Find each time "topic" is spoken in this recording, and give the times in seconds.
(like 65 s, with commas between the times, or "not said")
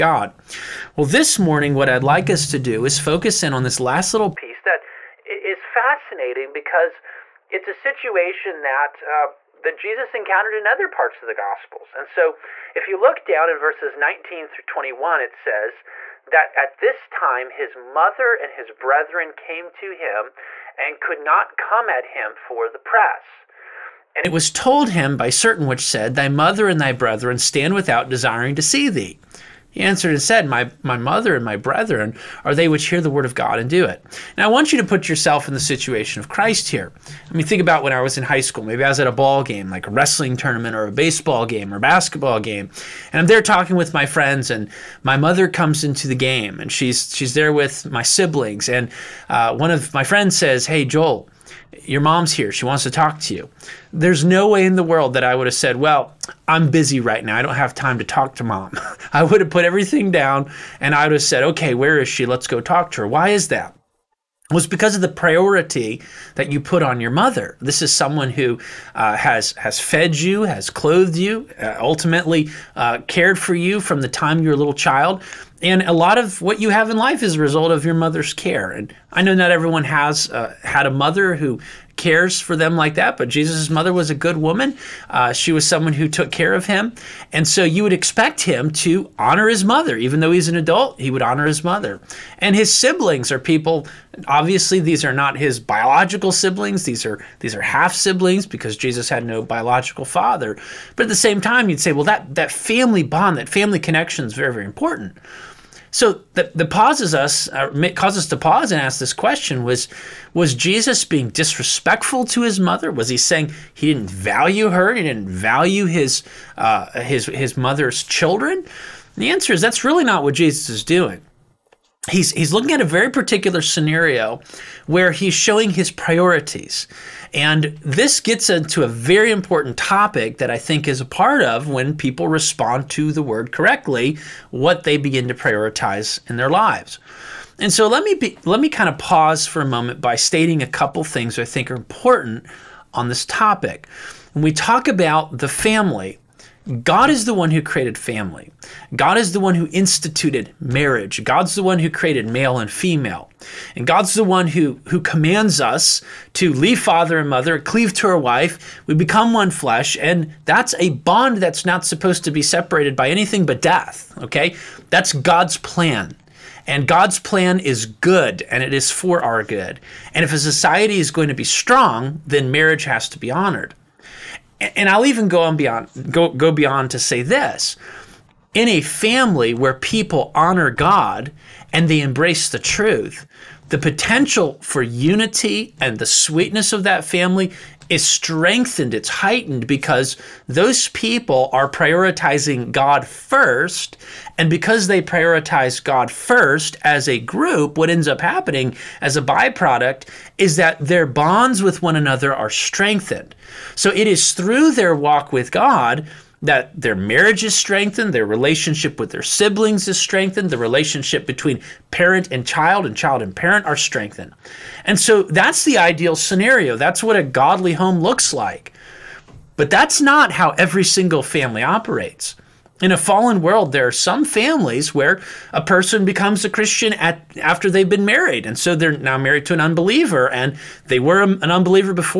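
129 s, 143 s.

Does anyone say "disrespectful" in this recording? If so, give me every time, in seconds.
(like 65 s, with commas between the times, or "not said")
111 s.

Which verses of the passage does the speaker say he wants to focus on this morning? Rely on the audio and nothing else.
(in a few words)
19 through 21.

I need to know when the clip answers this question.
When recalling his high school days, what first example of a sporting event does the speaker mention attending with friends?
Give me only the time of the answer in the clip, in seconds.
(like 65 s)
39 s.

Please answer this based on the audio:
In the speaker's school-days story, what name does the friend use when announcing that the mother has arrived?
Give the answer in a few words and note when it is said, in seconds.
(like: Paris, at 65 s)
Joel, at 50 s.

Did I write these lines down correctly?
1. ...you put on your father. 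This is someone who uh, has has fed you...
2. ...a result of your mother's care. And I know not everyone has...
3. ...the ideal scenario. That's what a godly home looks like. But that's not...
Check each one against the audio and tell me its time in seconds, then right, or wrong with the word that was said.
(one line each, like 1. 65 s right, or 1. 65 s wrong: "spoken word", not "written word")
1. 66 s wrong: "mother", not "father"
2. 77 s right
3. 215 s right.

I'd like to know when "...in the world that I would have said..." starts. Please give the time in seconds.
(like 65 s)
54 s.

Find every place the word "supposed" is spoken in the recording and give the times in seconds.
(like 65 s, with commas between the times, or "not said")
161 s.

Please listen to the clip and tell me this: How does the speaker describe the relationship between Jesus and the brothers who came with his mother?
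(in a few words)
Half siblings.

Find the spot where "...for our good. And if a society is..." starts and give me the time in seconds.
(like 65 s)
168 s.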